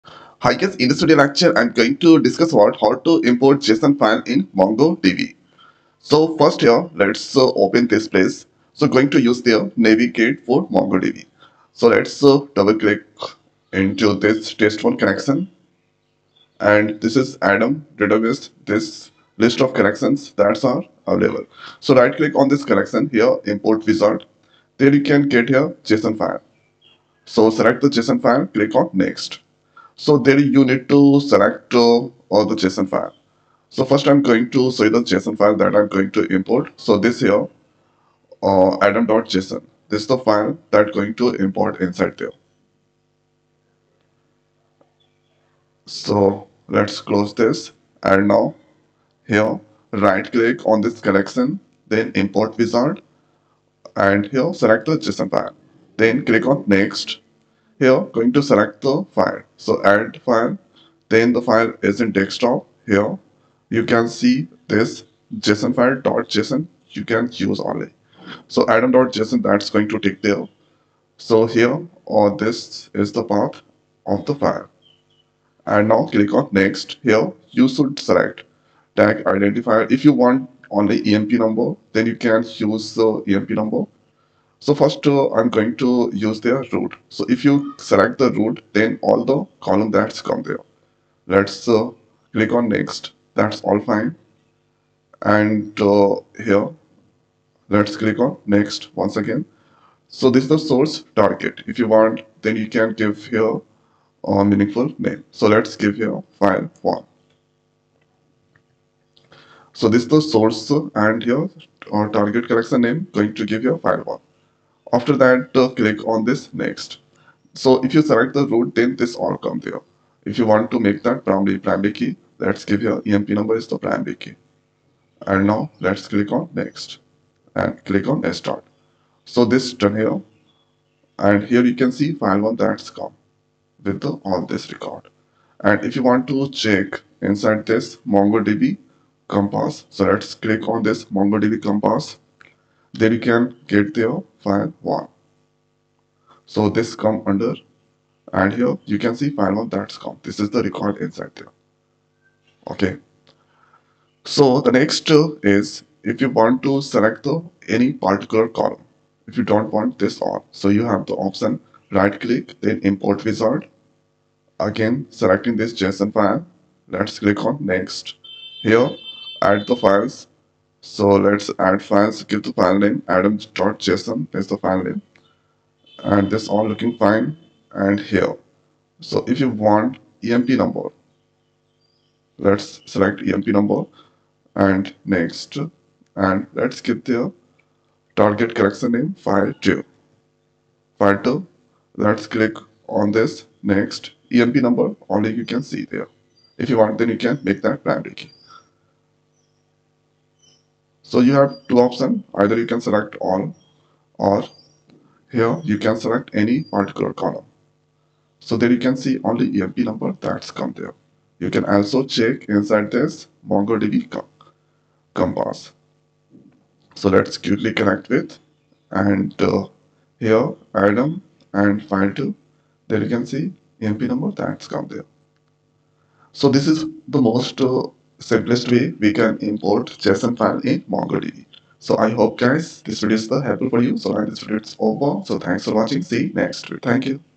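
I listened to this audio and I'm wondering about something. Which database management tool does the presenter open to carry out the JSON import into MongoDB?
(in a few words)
Navicat.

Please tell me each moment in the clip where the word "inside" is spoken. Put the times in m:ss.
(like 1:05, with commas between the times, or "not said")
0:41, 2:17, 2:30, 3:32.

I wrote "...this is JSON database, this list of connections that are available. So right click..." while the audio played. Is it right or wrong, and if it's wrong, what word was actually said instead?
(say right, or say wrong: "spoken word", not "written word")
wrong: "Adam", not "JSON".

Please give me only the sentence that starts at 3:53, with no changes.
So I this video is over.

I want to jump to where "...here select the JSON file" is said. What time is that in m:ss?
0:54.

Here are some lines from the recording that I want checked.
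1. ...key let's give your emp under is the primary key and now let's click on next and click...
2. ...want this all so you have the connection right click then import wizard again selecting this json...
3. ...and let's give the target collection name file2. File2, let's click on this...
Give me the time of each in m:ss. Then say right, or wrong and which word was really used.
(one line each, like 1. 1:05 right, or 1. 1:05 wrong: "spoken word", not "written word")
1. 2:01 wrong: "number", not "under"
2. 2:39 wrong: "option", not "connection"
3. 3:06 right.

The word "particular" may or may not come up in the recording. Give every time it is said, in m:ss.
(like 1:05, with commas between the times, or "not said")
2:37, 3:26.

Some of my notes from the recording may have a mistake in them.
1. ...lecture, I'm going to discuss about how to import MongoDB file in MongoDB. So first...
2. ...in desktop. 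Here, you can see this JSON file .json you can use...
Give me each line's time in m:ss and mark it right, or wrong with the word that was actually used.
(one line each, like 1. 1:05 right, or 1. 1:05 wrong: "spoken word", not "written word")
1. 0:01 wrong: "JSON", not "MongoDB"
2. 1:01 right.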